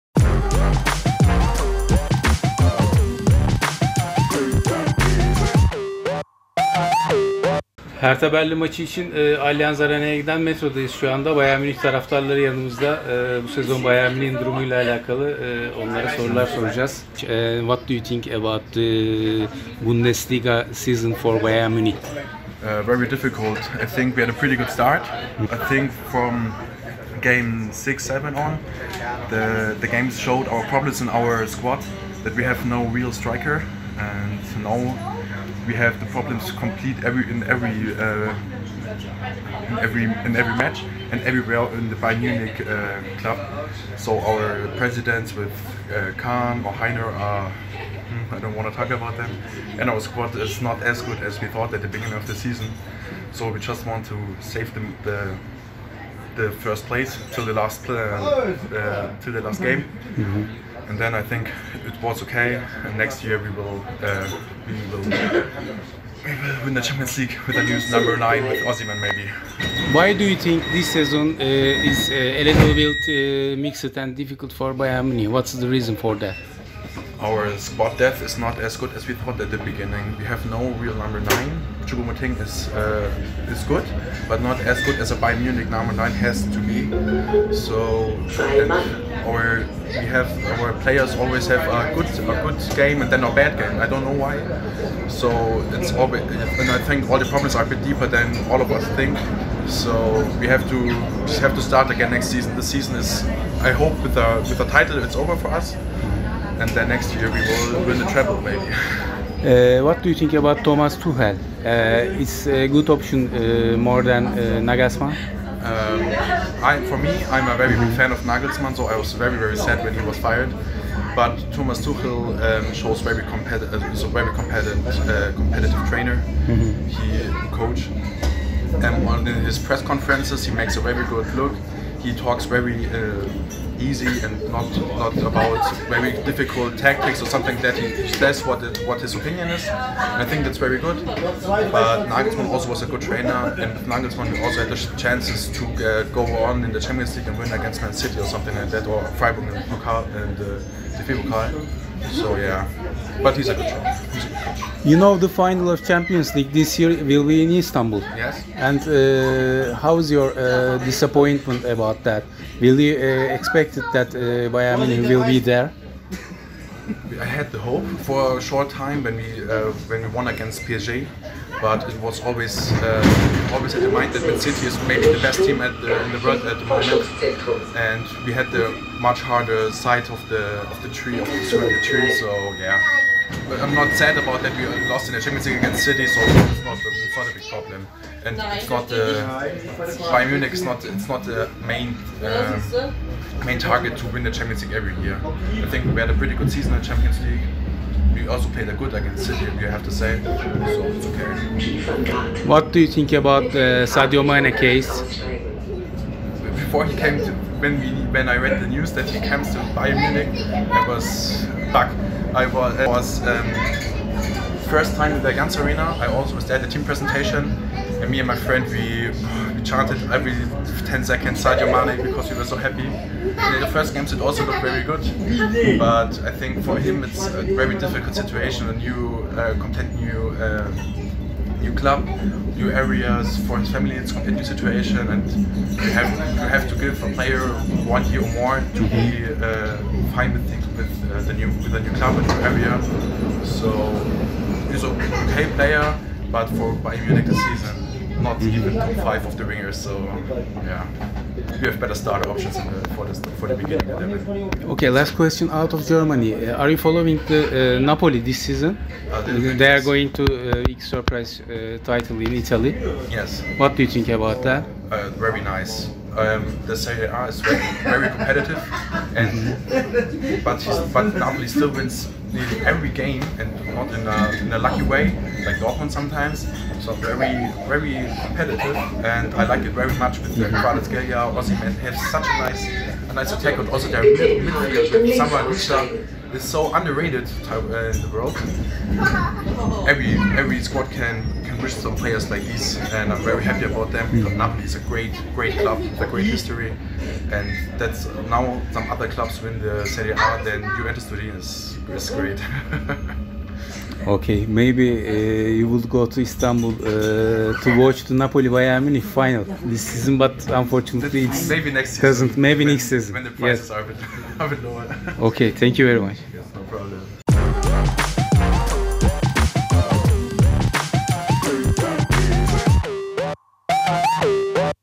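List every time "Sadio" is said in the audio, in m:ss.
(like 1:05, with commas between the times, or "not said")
3:23, 3:41.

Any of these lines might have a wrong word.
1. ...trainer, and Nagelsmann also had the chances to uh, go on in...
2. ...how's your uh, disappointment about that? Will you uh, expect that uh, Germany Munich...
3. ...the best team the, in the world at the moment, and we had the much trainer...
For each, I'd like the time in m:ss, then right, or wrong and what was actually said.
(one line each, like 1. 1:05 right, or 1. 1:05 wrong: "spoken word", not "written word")
1. 2:23 right
2. 2:39 wrong: "Bayern", not "Germany"
3. 2:55 wrong: "harder", not "trainer".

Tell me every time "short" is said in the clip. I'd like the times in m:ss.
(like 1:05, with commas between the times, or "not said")
2:48.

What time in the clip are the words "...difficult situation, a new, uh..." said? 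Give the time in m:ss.
3:47.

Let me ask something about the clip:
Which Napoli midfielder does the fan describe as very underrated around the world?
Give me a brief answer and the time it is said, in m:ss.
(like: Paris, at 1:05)
Samba, at 4:45.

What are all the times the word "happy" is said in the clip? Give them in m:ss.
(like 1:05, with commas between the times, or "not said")
3:42, 4:53.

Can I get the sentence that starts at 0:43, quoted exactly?
So our presidents with uh, Kahn or Hainer are.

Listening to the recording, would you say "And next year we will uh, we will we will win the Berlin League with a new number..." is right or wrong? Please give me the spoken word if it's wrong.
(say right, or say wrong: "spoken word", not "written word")
wrong: "Champions", not "Berlin".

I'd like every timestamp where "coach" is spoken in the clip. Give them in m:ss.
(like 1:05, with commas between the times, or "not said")
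2:07, 2:33.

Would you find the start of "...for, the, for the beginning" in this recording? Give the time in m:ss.
4:12.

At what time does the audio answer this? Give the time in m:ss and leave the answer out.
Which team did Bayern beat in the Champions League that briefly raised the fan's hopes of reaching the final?
2:50.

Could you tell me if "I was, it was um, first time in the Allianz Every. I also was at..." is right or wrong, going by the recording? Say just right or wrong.
wrong.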